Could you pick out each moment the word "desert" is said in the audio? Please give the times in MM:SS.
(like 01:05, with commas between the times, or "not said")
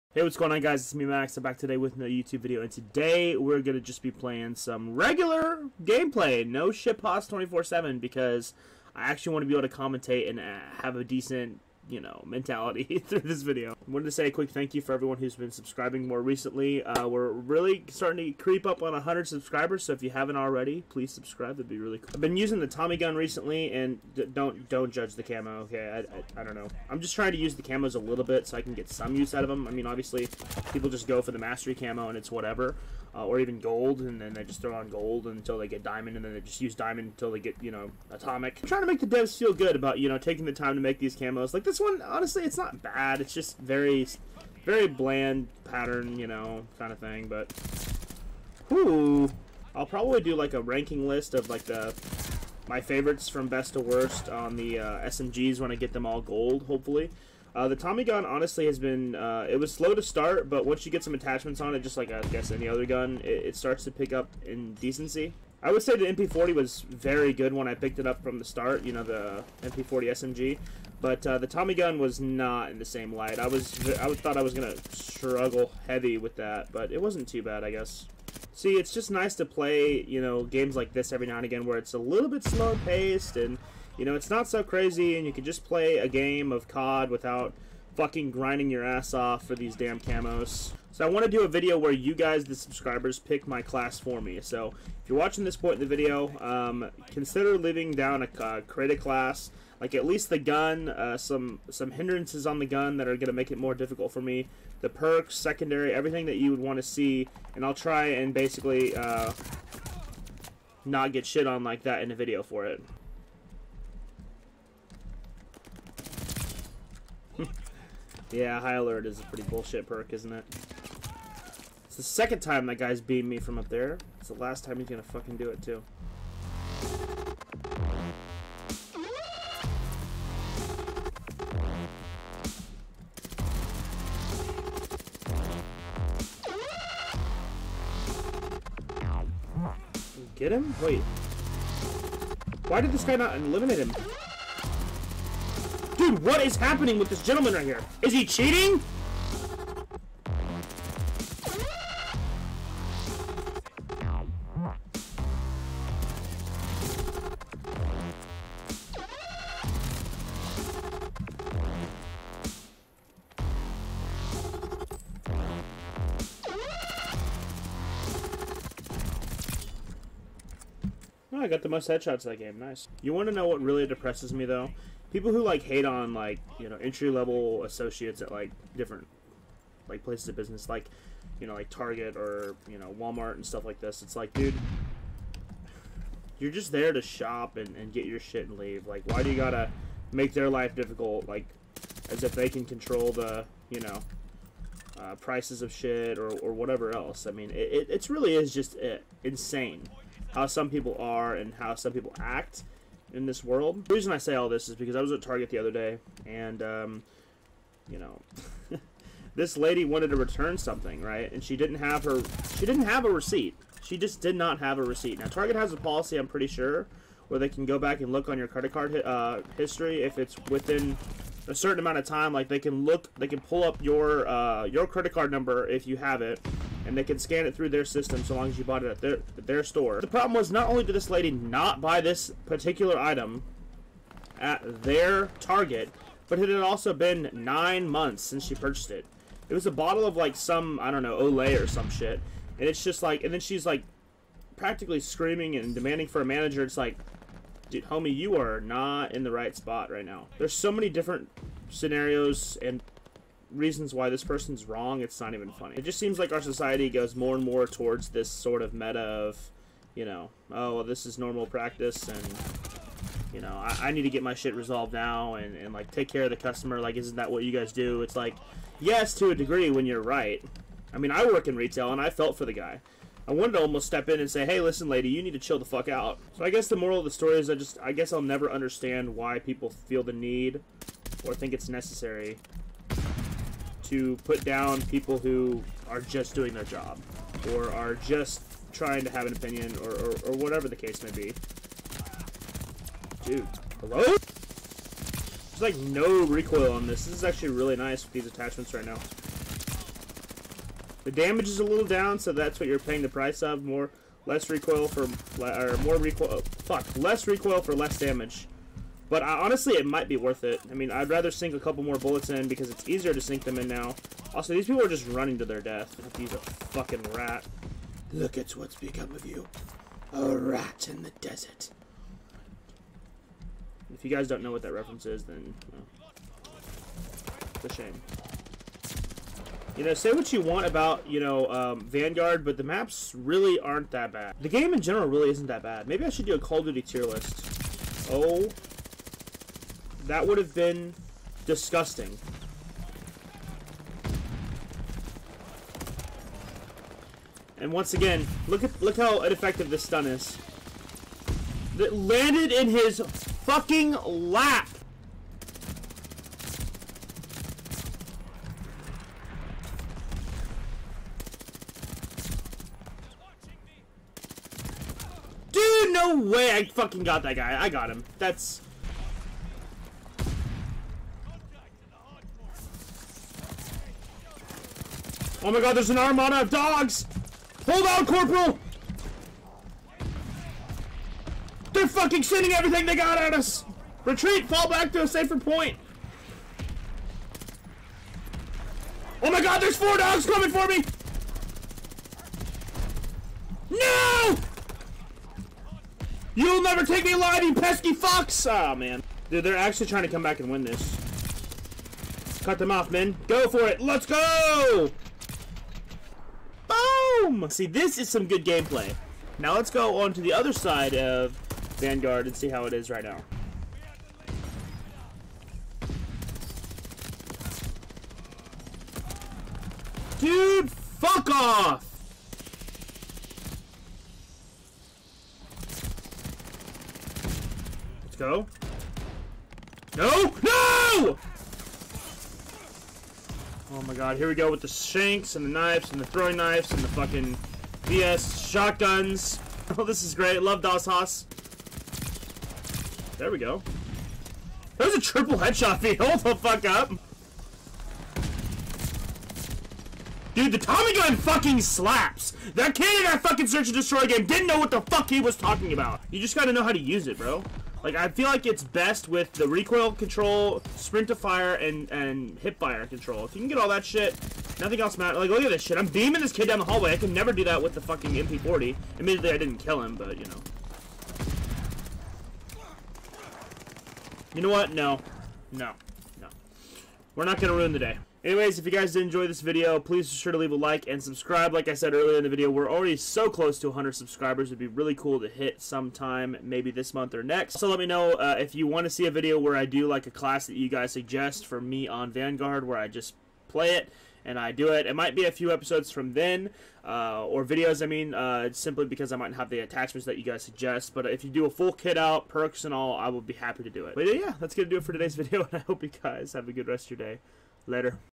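05:21.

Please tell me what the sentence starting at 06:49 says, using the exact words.
Now let's go on to the other side of Vanguard and see how it is right now.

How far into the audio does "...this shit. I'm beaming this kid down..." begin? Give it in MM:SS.
07:45.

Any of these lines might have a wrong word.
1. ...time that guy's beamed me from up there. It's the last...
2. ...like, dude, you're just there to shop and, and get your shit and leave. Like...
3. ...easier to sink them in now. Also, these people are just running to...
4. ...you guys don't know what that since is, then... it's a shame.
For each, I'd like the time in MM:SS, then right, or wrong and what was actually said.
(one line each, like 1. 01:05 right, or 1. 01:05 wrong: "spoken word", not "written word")
1. 02:02 right
2. 03:04 right
3. 05:12 right
4. 05:24 wrong: "reference", not "since".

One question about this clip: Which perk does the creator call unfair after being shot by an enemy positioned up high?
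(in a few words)
High alert.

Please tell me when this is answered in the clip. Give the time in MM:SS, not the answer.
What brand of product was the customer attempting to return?
04:01.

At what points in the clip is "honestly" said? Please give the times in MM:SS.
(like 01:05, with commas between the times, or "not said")
00:42, 00:58, 05:09.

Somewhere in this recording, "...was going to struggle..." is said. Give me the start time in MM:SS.
01:14.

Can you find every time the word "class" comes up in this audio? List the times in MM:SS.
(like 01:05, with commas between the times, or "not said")
01:33, 01:38, 08:10.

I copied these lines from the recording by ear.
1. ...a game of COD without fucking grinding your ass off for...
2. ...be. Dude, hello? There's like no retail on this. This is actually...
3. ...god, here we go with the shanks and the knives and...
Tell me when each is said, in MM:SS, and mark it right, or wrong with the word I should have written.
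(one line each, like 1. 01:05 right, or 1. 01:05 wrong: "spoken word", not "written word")
1. 01:25 right
2. 04:51 wrong: "recoil", not "retail"
3. 07:13 right.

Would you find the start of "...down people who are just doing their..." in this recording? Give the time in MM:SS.
04:44.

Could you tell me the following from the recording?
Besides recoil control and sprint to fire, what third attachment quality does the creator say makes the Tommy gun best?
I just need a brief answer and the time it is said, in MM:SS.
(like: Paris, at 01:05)
Hip fire control, at 07:42.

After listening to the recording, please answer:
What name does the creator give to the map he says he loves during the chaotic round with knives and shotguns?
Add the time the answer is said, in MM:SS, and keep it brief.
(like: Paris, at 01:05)
Das Haus, at 07:20.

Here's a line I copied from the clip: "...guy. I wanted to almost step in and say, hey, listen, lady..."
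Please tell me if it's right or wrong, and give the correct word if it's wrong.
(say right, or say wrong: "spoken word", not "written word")
right.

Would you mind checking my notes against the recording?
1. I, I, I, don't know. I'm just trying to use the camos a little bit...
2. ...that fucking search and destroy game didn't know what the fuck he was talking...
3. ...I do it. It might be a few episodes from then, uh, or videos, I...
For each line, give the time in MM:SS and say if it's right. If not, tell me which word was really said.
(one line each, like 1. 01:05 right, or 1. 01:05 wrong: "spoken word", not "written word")
1. 00:26 right
2. 07:33 right
3. 08:14 right.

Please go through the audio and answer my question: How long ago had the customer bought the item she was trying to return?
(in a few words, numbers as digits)
9 months.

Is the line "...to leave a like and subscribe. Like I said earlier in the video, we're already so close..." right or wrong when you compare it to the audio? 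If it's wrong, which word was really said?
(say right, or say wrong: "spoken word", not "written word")
right.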